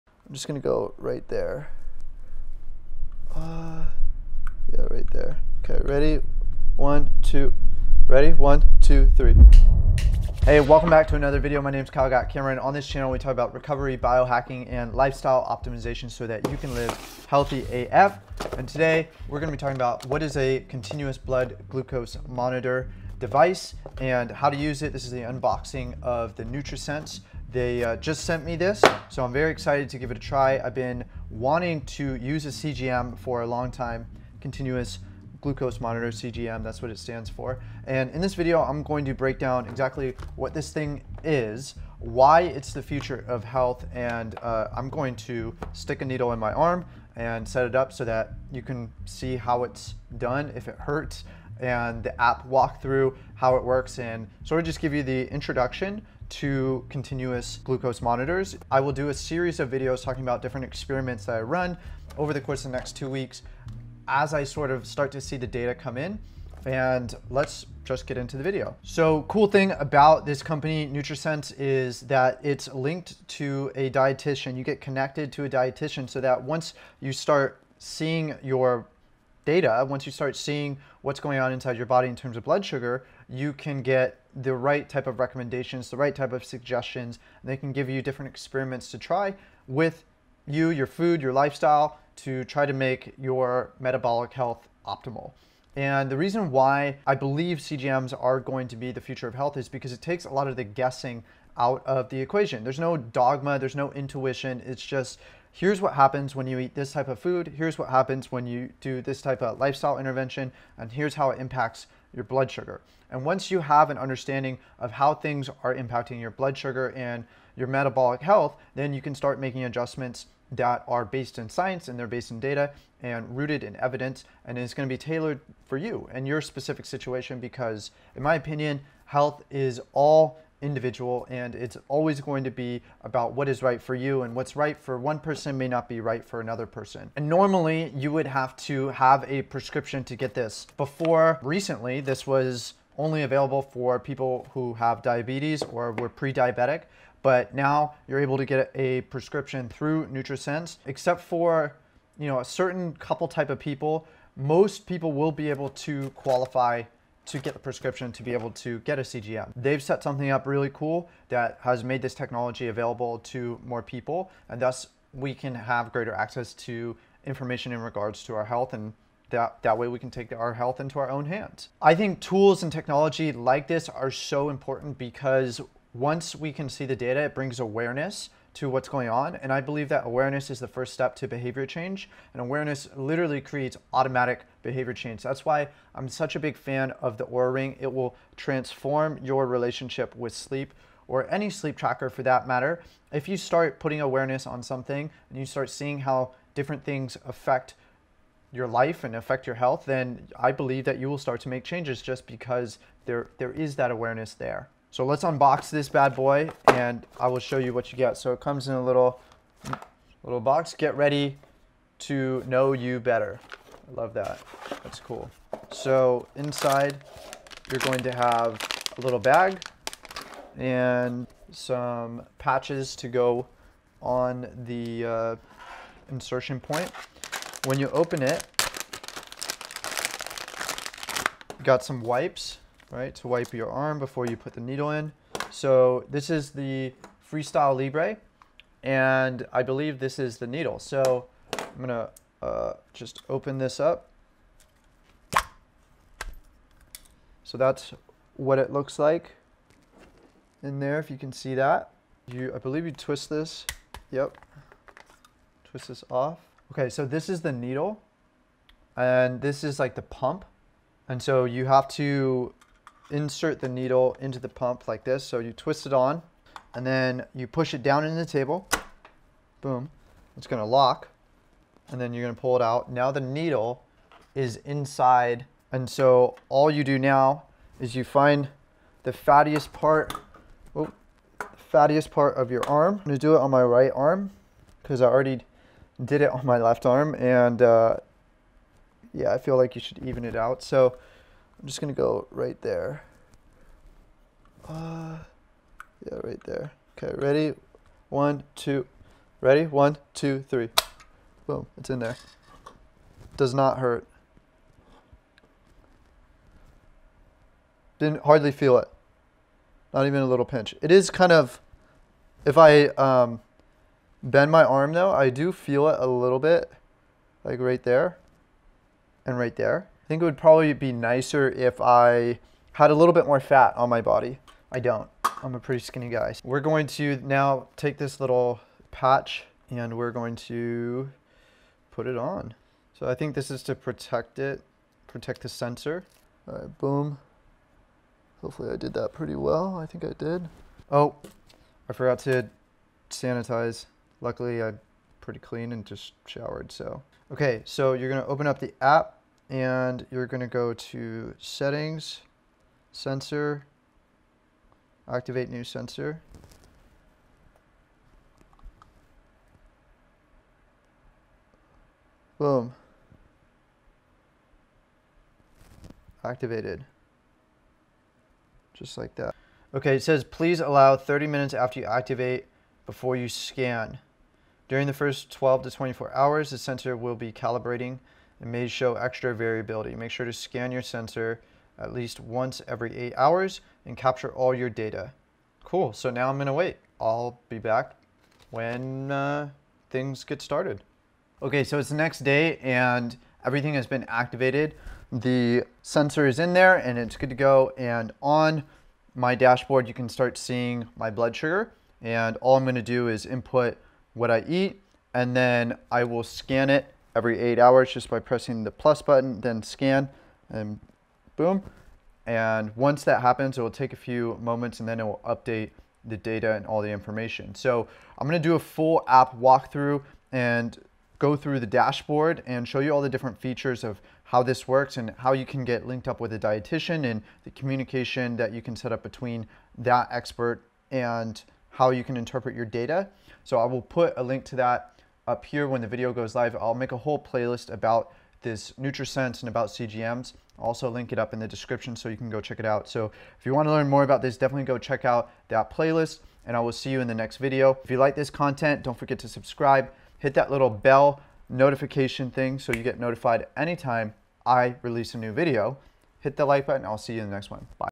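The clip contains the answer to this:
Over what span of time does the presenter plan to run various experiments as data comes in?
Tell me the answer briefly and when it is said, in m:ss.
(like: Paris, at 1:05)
2 weeks, at 1:02.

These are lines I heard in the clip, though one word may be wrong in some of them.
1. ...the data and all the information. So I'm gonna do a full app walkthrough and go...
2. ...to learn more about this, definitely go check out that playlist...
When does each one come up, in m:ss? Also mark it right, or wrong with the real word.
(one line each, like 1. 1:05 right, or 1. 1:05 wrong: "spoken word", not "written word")
1. 6:56 right
2. 7:23 right.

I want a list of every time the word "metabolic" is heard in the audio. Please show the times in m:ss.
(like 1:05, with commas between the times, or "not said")
1:33, 1:57.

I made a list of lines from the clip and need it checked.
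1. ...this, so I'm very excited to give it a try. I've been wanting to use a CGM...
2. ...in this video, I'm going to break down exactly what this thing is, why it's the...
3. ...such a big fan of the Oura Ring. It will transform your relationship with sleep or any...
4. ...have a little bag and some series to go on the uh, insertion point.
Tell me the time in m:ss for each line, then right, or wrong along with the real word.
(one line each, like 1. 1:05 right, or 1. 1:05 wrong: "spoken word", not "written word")
1. 0:28 right
2. 0:38 right
3. 3:06 right
4. 3:38 wrong: "patches", not "series".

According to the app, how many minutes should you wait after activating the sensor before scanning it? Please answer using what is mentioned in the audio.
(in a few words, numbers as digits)
30.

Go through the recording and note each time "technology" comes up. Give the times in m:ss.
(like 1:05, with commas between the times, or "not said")
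2:42, 2:52.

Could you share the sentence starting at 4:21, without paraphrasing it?
And so you have to insert the needle into the pump like this.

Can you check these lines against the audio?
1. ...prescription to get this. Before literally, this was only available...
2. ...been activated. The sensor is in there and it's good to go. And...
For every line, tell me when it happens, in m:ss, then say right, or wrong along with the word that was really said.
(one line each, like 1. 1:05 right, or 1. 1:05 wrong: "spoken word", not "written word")
1. 2:19 wrong: "recently", not "literally"
2. 6:33 right.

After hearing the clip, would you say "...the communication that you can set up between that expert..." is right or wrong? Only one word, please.
right.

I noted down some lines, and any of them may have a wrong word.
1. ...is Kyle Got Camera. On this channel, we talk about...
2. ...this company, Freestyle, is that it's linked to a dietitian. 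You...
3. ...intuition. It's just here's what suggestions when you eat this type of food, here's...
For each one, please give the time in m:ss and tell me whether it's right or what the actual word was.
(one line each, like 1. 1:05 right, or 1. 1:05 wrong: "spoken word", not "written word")
1. 0:11 right
2. 1:10 wrong: "NutriSense", not "Freestyle"
3. 1:43 wrong: "happens", not "suggestions".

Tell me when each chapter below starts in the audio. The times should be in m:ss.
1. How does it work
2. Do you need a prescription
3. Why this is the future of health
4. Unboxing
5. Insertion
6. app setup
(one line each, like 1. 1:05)
1. 1:08
2. 2:19
3. 2:52
4. 3:29
5. 4:38
6. 5:50.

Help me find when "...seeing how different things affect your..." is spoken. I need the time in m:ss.
3:15.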